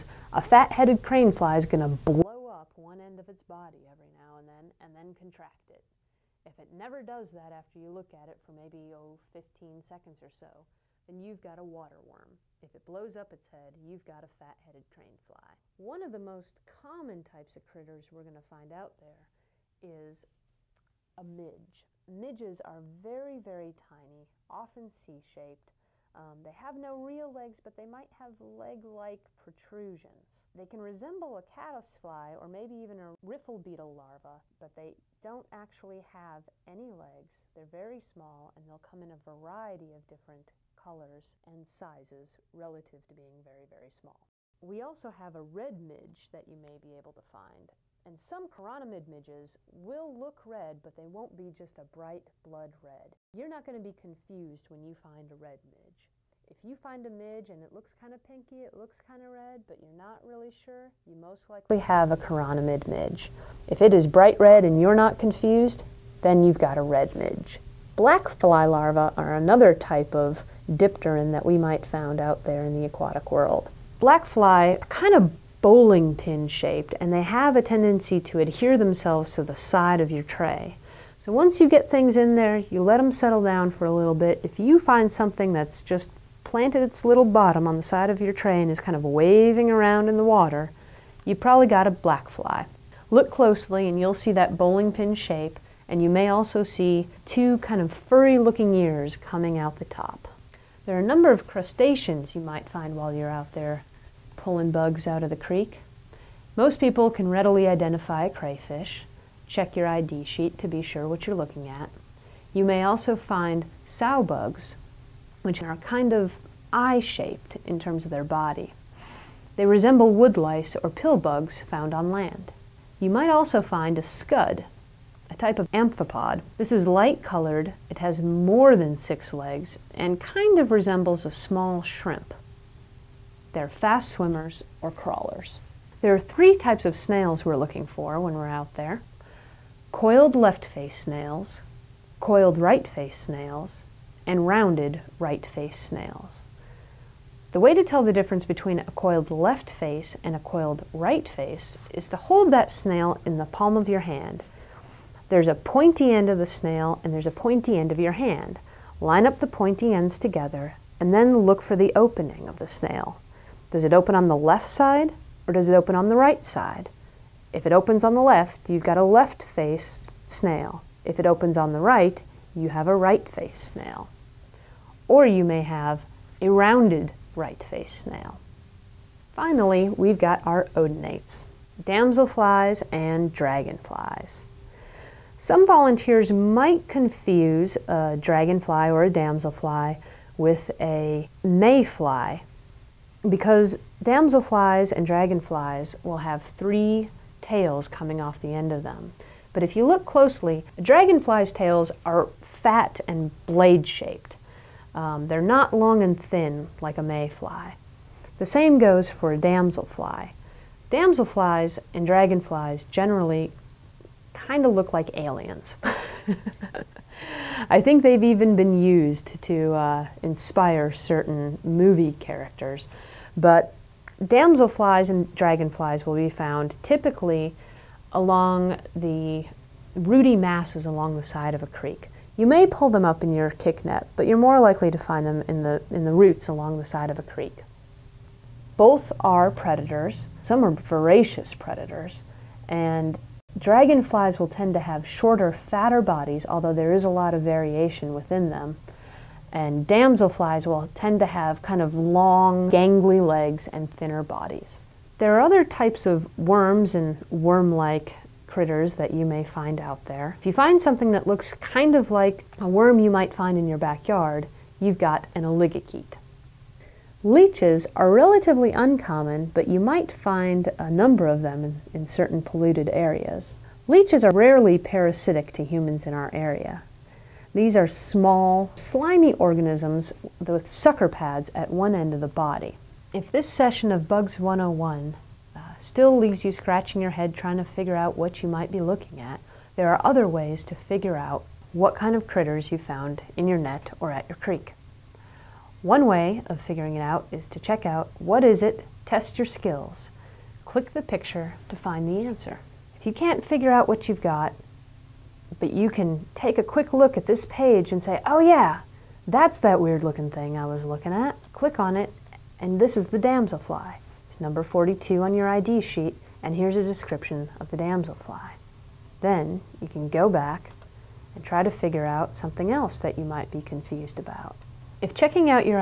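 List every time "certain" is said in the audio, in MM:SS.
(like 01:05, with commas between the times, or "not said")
03:40, 04:32.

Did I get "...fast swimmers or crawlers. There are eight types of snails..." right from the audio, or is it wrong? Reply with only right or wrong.
wrong.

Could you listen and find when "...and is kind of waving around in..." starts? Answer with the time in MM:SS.
01:28.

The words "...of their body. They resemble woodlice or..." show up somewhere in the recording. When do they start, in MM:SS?
01:58.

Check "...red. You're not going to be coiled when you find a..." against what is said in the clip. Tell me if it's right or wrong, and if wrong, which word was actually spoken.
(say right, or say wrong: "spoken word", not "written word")
wrong: "confused", not "coiled".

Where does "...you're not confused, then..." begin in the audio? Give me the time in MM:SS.
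01:04.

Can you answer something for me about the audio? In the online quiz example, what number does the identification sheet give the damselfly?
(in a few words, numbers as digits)
42.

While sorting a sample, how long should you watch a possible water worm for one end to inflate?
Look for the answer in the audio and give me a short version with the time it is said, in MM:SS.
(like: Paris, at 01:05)
15 seconds, at 00:09.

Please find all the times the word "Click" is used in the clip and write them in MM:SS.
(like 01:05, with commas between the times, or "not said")
05:00, 05:11.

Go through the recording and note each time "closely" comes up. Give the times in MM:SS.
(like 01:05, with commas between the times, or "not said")
01:33, 03:20.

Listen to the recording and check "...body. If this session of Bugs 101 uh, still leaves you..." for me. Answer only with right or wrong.
right.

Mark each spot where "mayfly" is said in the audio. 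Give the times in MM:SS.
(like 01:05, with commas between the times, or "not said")
03:11, 03:27.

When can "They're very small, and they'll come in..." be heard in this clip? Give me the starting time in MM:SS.
00:37.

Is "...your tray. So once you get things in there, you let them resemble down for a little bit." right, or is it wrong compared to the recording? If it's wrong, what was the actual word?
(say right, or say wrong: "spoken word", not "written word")
wrong: "settle", not "resemble".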